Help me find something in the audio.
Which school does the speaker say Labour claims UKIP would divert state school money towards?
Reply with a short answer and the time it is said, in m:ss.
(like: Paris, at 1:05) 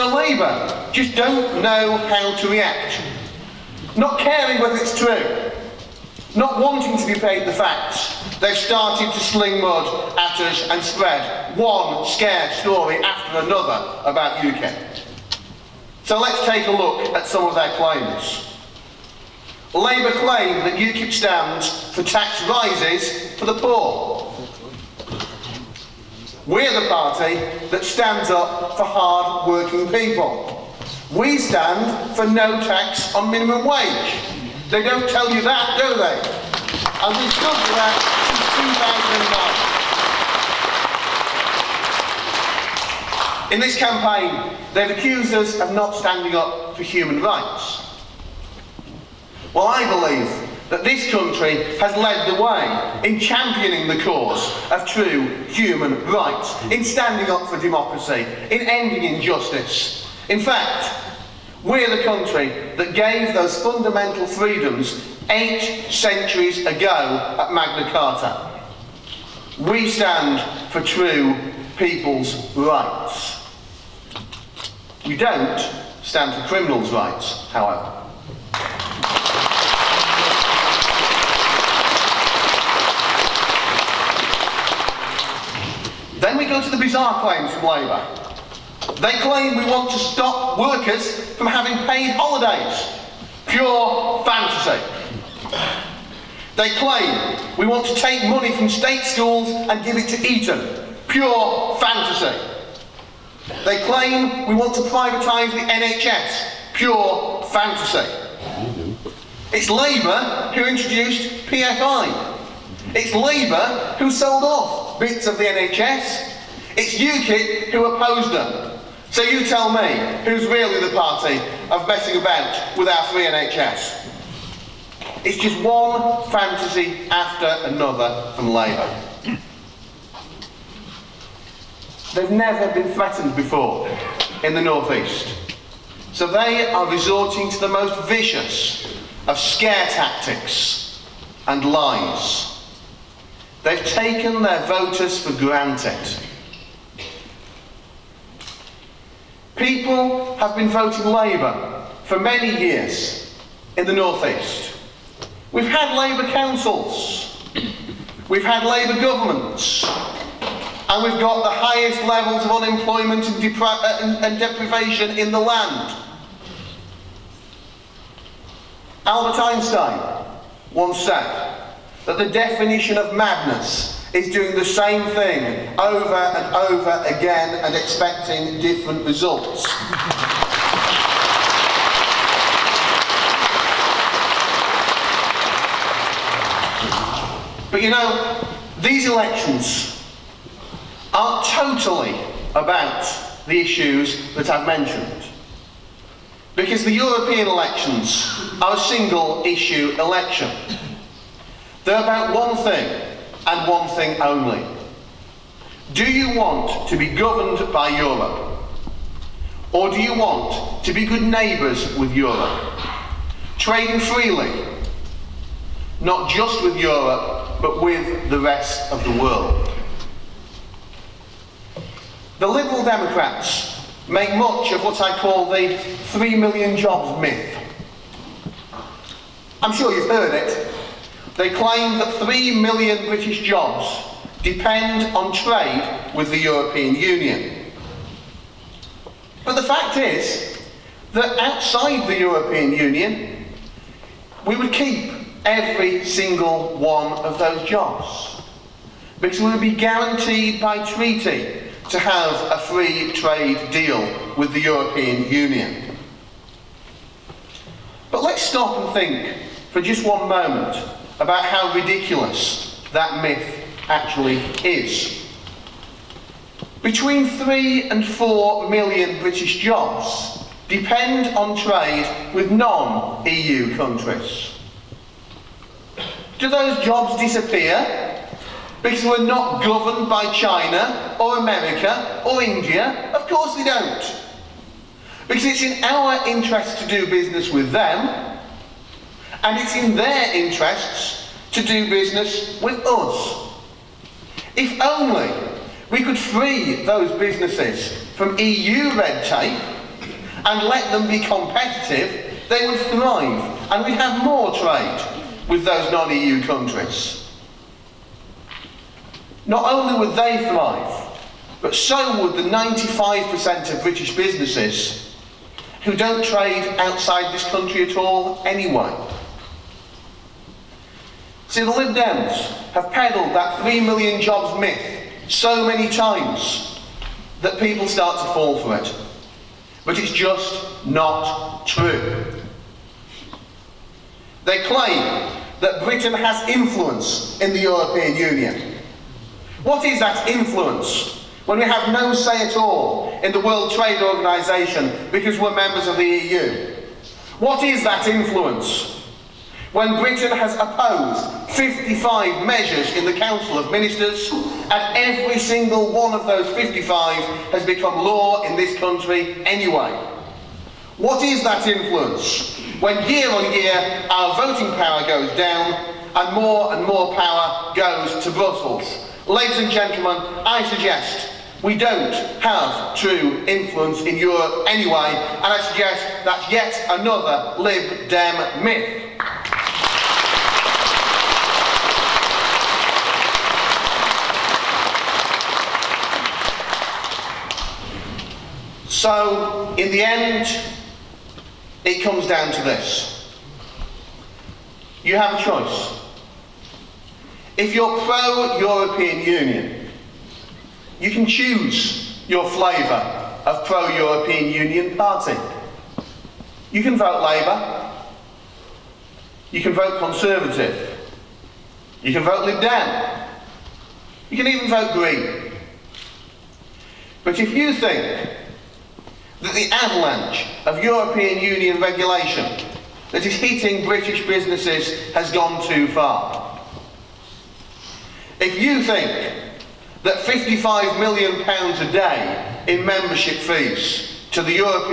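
Eton, at 1:40.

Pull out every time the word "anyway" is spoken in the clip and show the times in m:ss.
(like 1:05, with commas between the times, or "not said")
5:18, 5:59, 6:14.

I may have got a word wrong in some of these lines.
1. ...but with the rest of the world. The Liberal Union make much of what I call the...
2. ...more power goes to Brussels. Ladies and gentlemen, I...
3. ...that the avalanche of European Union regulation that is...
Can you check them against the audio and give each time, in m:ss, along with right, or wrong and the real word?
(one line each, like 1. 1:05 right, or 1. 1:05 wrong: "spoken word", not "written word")
1. 3:37 wrong: "Democrats", not "Union"
2. 6:06 right
3. 6:59 right.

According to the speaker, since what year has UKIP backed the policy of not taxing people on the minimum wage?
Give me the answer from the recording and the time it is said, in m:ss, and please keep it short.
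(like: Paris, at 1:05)
2009, at 0:43.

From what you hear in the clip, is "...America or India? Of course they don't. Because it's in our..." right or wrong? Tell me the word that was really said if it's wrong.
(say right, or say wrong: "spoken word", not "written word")
right.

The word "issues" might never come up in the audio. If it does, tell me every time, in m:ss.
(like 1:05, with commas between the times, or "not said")
3:13, 3:19.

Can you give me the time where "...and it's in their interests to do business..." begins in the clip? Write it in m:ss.
4:49.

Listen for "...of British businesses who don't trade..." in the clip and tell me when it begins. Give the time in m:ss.
5:13.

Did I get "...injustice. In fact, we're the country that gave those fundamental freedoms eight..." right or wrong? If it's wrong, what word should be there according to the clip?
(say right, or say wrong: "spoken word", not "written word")
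right.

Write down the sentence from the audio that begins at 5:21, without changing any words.
See, the Lib Dems have peddled that 3 million jobs myth so many times that people start to fall for it.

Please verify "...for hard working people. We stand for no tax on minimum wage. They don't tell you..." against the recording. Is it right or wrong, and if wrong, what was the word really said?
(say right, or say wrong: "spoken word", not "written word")
right.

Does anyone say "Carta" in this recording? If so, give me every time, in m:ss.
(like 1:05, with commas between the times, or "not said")
1:07.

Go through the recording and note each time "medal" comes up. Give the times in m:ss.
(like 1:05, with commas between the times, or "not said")
not said.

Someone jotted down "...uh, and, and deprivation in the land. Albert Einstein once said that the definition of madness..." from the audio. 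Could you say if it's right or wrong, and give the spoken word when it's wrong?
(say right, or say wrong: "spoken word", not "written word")
right.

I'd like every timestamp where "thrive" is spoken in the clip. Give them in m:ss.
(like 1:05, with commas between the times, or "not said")
5:02, 5:10.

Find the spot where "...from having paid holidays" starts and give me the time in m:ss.
1:31.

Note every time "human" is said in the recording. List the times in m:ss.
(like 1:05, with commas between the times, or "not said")
0:46, 0:55.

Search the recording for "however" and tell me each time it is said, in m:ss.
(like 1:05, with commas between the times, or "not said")
1:17.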